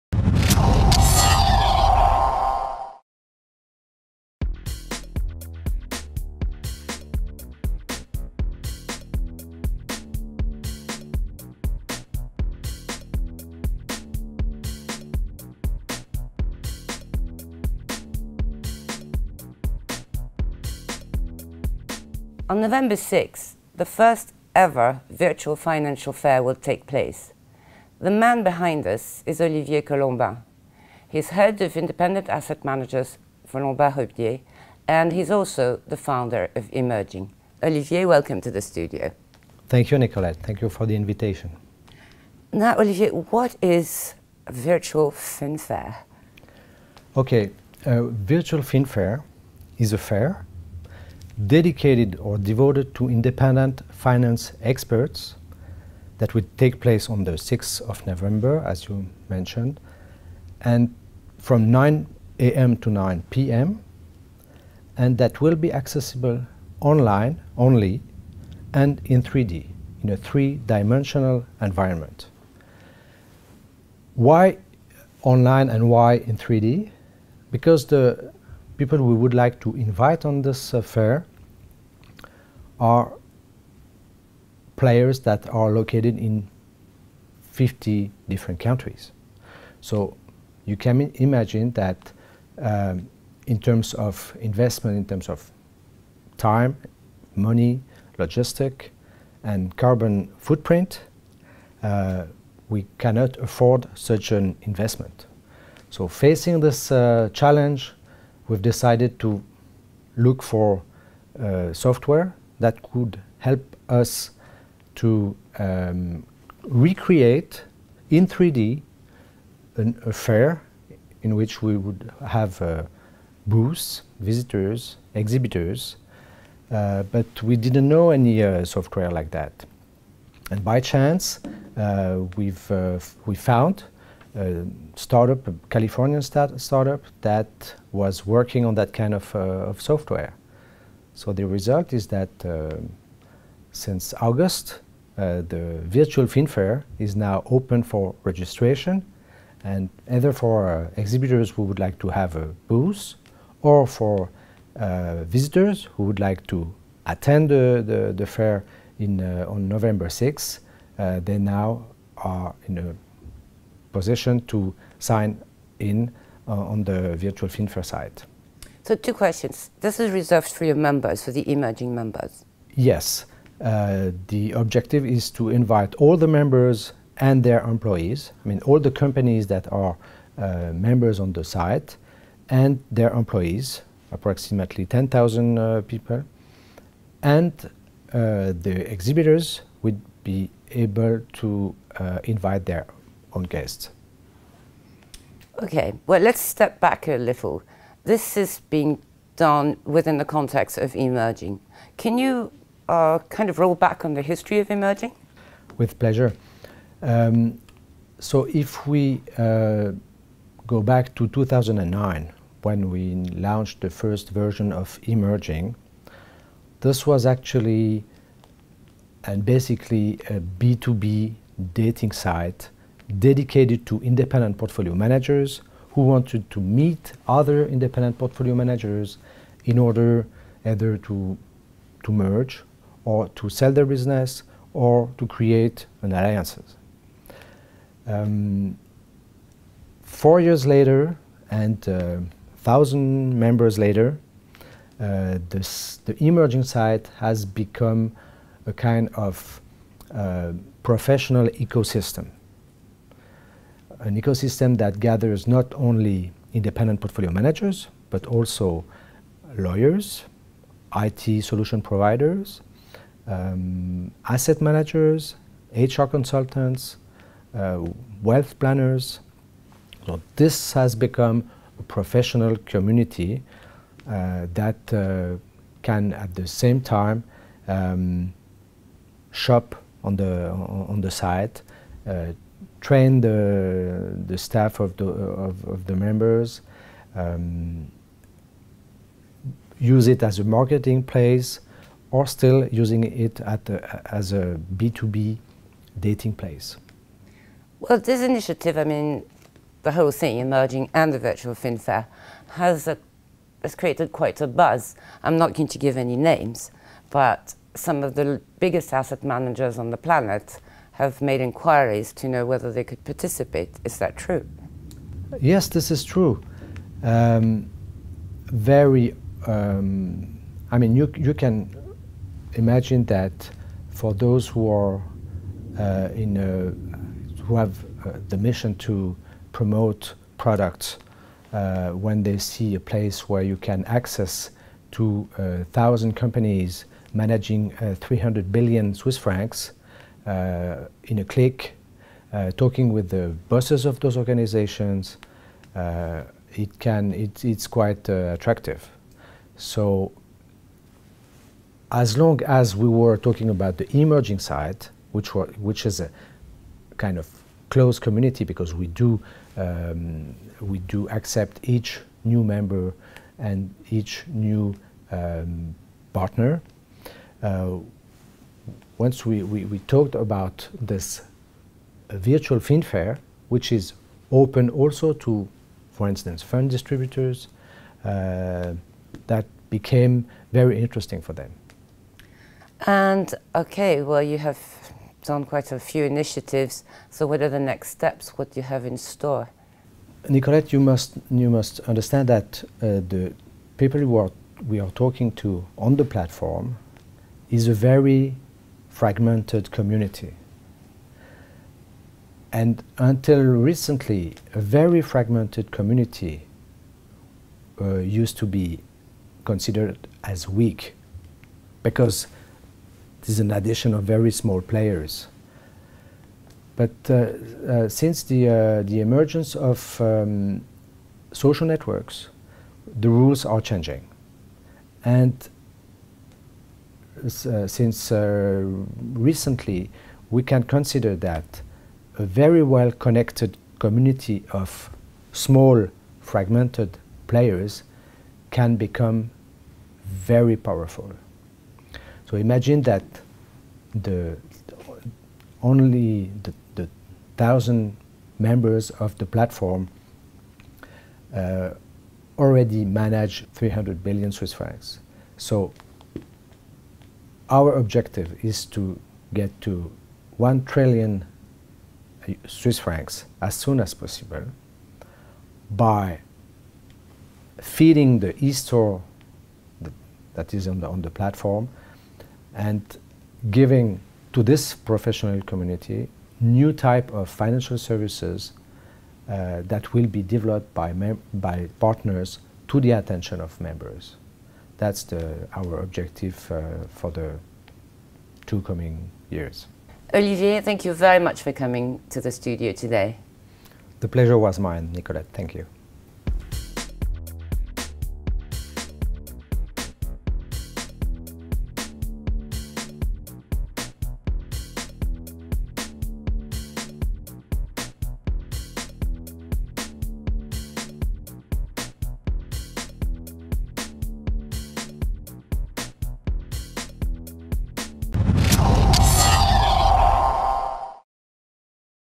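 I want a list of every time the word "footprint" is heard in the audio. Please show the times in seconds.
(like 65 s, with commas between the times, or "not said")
100 s.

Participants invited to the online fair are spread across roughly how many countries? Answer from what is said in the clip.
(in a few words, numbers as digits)
50.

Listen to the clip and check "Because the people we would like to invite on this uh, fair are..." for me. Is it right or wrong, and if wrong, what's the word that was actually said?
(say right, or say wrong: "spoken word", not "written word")
right.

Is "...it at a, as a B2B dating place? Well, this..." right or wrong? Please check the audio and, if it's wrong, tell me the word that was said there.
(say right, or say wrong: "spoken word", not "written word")
right.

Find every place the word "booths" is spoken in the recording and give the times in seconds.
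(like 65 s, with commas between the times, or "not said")
123 s, 152 s.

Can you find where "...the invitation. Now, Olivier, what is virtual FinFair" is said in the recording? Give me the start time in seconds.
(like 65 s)
40 s.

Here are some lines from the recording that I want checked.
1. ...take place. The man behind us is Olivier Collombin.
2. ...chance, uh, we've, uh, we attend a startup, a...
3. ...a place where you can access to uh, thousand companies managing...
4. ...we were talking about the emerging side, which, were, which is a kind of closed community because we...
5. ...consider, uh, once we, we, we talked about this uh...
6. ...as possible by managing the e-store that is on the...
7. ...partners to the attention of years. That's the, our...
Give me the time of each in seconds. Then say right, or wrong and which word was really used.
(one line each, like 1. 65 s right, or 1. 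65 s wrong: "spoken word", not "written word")
1. 26 s right
2. 130 s wrong: "found", not "attend"
3. 332 s right
4. 352 s right
5. 366 s wrong: "partner", not "consider"
6. 463 s wrong: "feeding", not "managing"
7. 481 s wrong: "members", not "years".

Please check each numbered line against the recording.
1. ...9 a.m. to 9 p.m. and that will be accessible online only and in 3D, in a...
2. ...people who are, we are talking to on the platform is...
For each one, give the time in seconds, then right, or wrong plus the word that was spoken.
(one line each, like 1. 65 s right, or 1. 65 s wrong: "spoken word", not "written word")
1. 61 s right
2. 393 s right.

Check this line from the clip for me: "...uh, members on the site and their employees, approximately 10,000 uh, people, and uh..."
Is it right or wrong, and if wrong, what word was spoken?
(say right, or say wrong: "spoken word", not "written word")
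right.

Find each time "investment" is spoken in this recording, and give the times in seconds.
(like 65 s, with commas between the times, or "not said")
94 s, 104 s.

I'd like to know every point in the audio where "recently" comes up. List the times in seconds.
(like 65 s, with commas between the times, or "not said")
403 s, 429 s.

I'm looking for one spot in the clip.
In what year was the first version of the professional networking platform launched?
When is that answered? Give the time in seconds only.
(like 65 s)
211 s.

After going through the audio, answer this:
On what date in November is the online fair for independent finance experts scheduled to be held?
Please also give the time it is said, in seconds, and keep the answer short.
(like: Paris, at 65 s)
November 6, at 57 s.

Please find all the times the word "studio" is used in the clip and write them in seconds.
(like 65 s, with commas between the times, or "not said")
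38 s, 492 s.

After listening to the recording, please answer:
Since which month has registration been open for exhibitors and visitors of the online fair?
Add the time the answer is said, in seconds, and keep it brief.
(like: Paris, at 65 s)
August, at 144 s.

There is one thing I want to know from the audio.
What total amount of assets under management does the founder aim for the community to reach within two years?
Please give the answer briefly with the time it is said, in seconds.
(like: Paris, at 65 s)
1 trillion Swiss francs, at 460 s.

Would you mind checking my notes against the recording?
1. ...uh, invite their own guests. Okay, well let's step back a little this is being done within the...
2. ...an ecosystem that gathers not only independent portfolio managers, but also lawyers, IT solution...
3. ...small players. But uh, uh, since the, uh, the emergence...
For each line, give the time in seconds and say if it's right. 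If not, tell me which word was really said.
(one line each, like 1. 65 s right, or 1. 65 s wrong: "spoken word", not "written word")
1. 191 s right
2. 254 s right
3. 414 s right.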